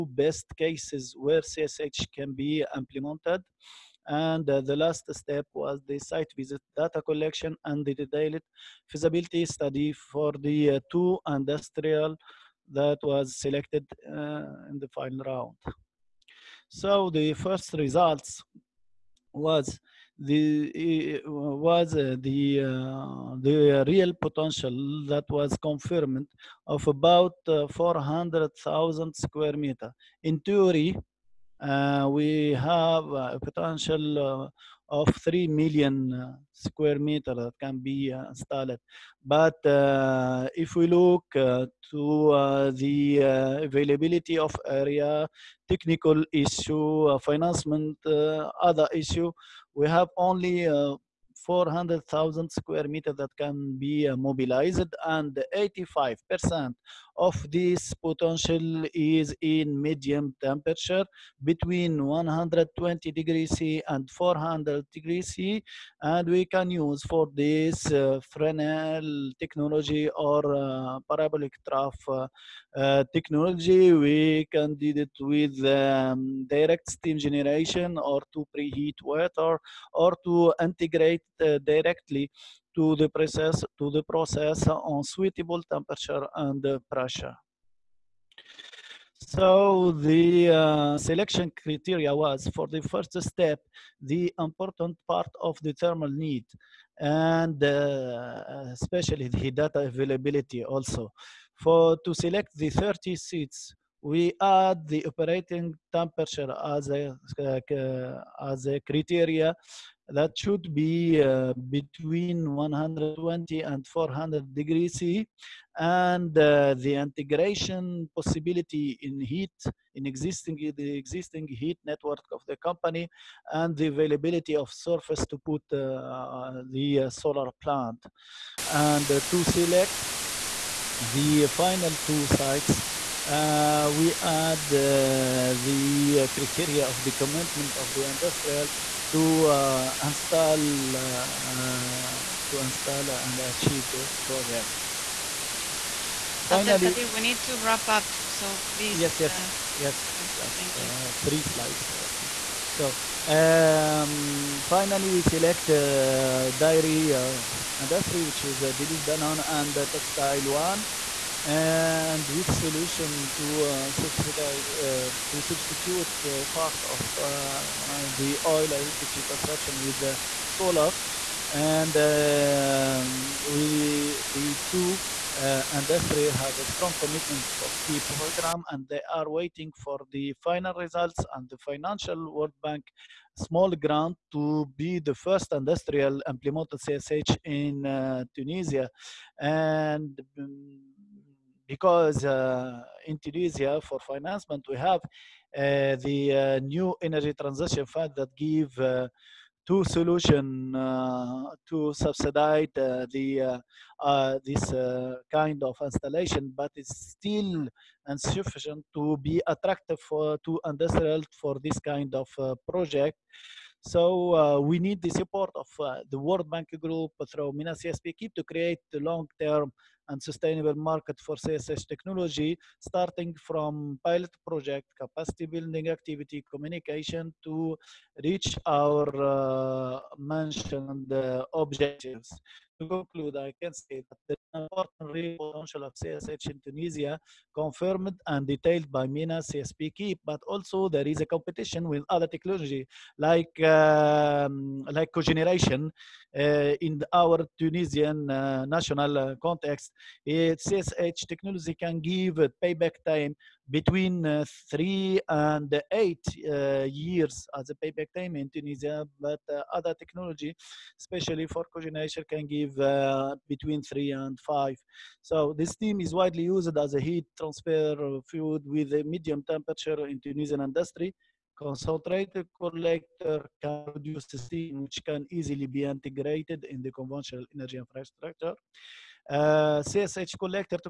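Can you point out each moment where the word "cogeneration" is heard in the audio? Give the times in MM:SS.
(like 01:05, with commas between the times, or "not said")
04:05, 04:21.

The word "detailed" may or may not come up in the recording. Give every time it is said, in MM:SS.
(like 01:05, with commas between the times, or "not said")
00:07, 03:58.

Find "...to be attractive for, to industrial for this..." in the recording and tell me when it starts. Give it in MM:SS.
03:28.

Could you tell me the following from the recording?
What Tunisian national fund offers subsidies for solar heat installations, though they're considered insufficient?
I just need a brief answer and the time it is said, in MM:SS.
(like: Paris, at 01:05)
Energy transition fund, at 03:17.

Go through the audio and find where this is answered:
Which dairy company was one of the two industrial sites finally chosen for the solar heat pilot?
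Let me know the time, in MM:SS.
02:38.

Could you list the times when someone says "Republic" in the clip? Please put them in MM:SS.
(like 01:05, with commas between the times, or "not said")
not said.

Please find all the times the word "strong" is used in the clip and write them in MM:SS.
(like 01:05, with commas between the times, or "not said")
02:56.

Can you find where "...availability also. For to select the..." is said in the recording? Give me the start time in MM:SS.
01:39.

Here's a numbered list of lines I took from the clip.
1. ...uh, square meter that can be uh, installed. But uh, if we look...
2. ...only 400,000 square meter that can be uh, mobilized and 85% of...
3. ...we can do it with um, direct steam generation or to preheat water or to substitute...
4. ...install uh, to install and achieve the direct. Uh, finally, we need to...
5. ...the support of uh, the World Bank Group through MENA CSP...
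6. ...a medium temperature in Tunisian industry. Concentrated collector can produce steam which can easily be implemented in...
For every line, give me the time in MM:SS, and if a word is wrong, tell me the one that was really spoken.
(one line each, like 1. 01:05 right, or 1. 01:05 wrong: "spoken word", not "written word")
1. 00:36 right
2. 00:50 right
3. 01:13 wrong: "integrate", not "substitute"
4. 02:20 wrong: "project", not "direct"
5. 03:35 right
6. 04:28 wrong: "integrated", not "implemented".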